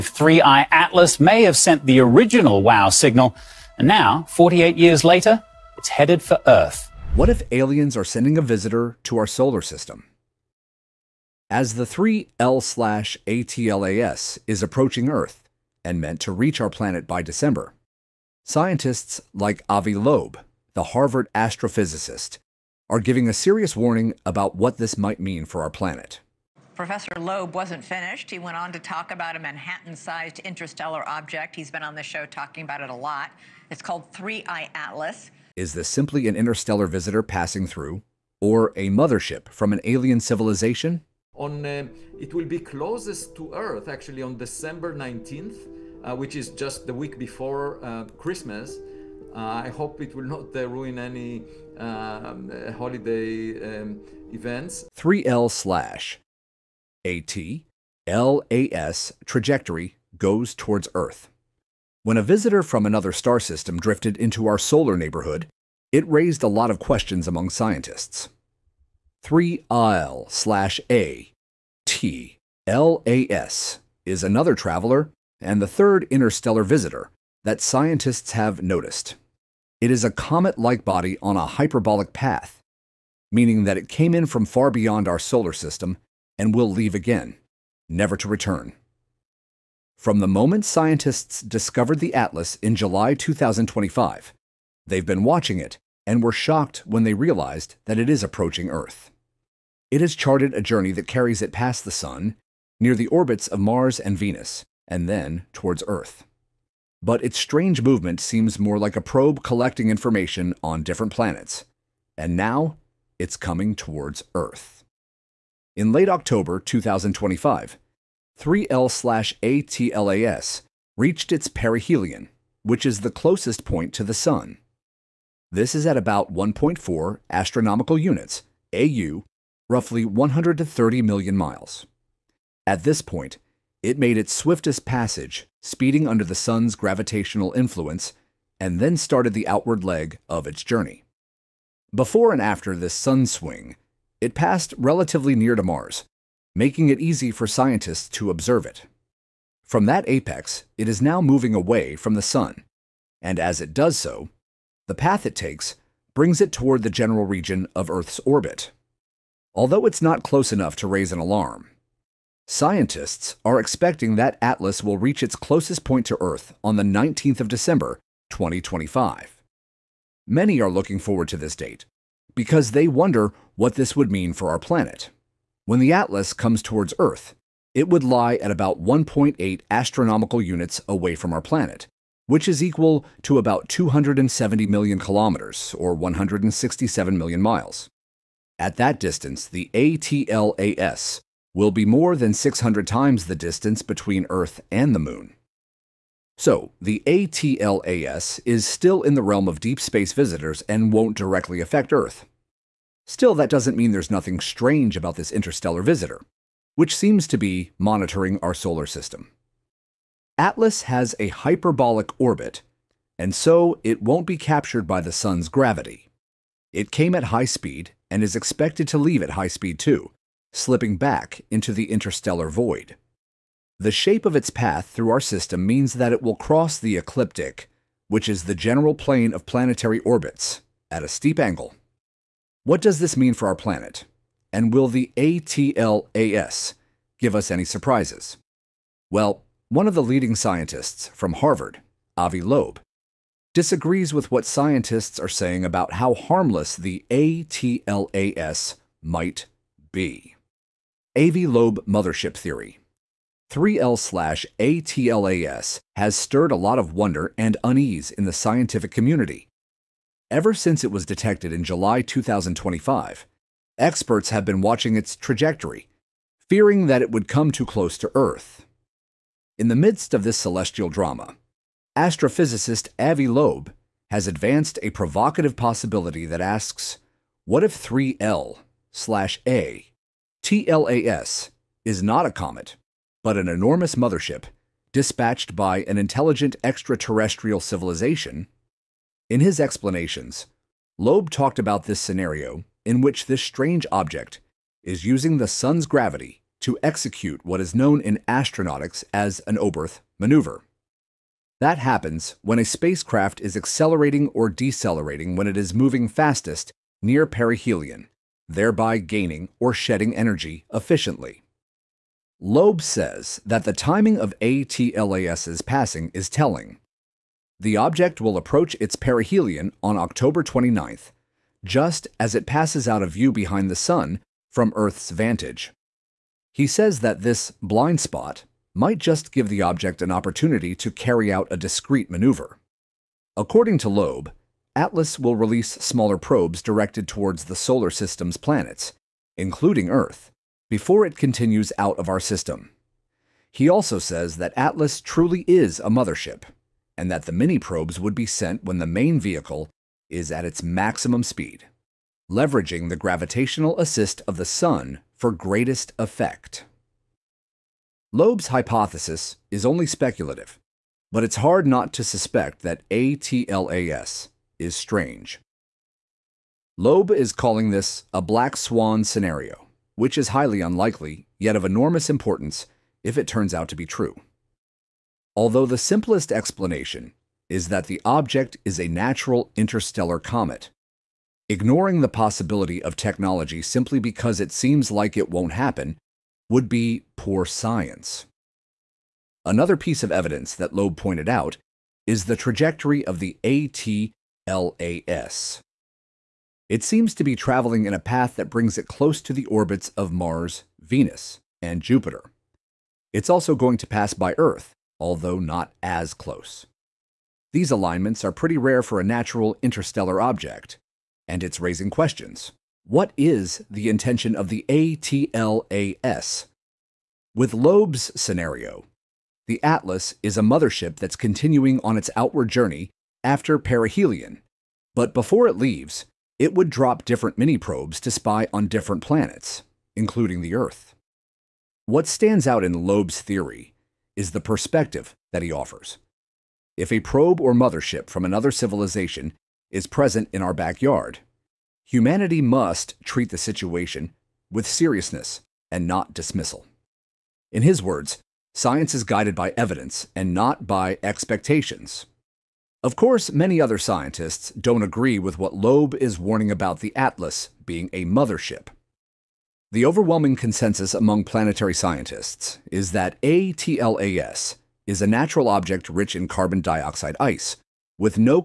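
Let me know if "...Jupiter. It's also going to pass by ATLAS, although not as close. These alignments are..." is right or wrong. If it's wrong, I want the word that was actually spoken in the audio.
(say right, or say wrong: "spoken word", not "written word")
wrong: "Earth", not "ATLAS".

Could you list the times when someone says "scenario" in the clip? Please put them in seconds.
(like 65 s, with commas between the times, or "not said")
291 s, 369 s, 418 s.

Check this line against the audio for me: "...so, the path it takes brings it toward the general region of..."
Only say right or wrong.
right.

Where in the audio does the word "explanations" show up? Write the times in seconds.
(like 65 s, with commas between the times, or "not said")
289 s, 376 s.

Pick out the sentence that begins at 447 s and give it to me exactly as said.
In his words, science is guided by evidence and not by expectations.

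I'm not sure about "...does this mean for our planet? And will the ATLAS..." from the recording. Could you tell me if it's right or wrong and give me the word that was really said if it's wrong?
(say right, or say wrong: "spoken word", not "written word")
right.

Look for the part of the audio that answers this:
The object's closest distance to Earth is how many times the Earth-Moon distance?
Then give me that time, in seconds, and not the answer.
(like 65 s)
192 s.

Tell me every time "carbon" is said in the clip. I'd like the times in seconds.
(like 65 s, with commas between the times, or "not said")
466 s.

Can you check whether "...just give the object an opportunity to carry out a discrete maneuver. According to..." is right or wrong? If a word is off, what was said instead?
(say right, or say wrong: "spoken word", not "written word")
right.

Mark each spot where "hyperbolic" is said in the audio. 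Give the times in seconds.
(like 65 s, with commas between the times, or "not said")
81 s, 211 s.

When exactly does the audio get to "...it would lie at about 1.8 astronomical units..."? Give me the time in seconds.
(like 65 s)
177 s.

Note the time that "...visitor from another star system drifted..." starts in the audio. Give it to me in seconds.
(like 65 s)
62 s.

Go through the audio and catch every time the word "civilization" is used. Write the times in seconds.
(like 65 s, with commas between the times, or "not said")
40 s, 287 s, 438 s.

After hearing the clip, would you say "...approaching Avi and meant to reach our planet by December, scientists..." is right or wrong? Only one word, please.
wrong.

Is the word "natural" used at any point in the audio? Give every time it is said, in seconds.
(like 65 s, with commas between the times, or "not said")
378 s, 409 s, 465 s.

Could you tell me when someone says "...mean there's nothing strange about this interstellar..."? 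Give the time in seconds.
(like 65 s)
203 s.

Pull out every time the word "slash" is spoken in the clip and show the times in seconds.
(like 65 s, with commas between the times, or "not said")
55 s, 70 s, 253 s, 278 s.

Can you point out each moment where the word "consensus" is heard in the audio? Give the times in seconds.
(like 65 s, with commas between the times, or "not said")
460 s.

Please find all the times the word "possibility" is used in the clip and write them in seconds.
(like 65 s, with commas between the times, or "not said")
275 s, 382 s.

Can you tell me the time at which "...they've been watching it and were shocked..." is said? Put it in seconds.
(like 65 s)
94 s.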